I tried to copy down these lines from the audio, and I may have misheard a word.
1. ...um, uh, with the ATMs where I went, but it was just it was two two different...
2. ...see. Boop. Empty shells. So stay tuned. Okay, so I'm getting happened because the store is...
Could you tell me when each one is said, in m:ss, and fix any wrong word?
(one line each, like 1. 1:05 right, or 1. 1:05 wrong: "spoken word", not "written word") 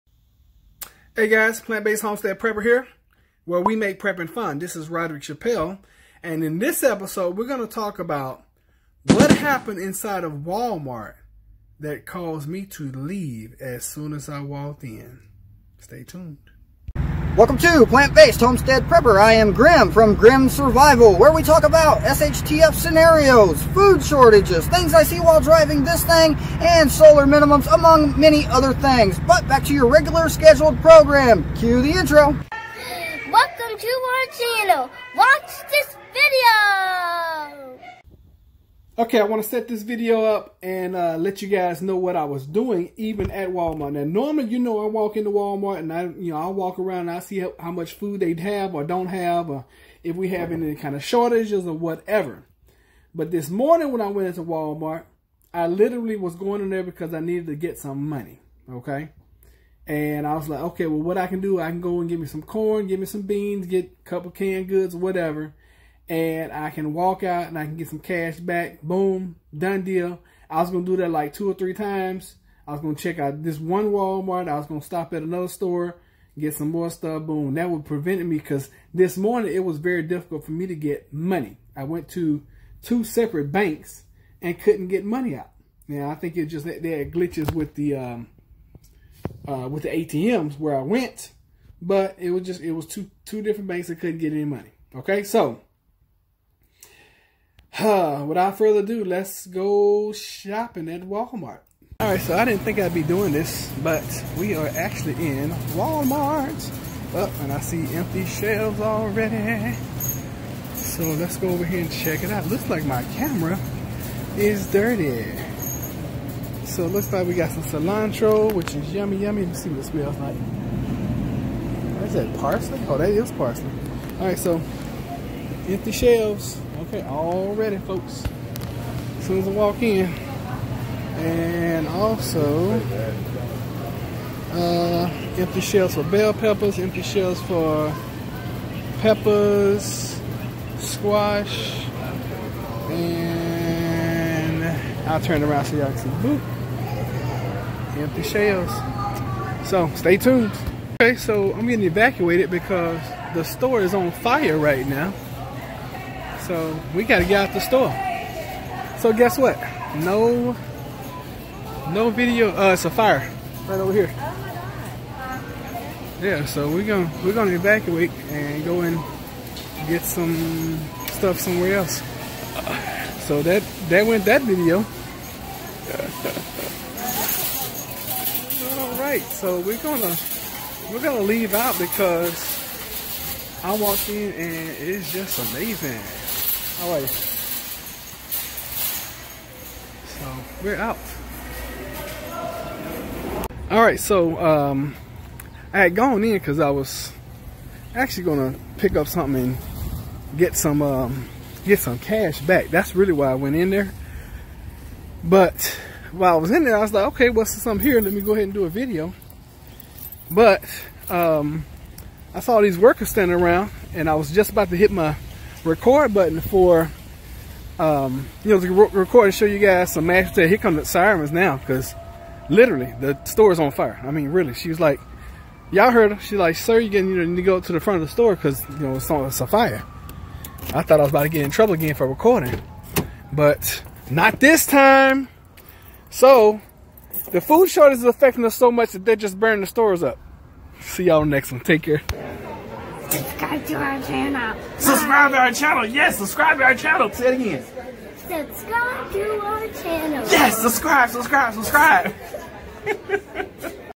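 1. 1:27 right
2. 2:25 wrong: "evacuated", not "happened".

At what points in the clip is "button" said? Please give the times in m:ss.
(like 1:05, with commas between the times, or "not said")
3:36.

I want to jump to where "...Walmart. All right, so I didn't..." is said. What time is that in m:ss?
1:41.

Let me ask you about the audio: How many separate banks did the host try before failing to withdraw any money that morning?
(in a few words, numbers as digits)
2.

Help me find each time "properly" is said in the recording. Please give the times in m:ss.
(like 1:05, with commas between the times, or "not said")
not said.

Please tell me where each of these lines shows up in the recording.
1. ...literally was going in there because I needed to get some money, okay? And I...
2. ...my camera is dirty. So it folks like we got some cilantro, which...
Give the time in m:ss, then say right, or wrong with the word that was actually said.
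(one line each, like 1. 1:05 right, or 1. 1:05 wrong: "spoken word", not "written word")
1. 0:55 right
2. 1:52 wrong: "looks", not "folks".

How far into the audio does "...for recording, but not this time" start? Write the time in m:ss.
3:51.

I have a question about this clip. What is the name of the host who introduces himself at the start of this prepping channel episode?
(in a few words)
Roderick Chappelle.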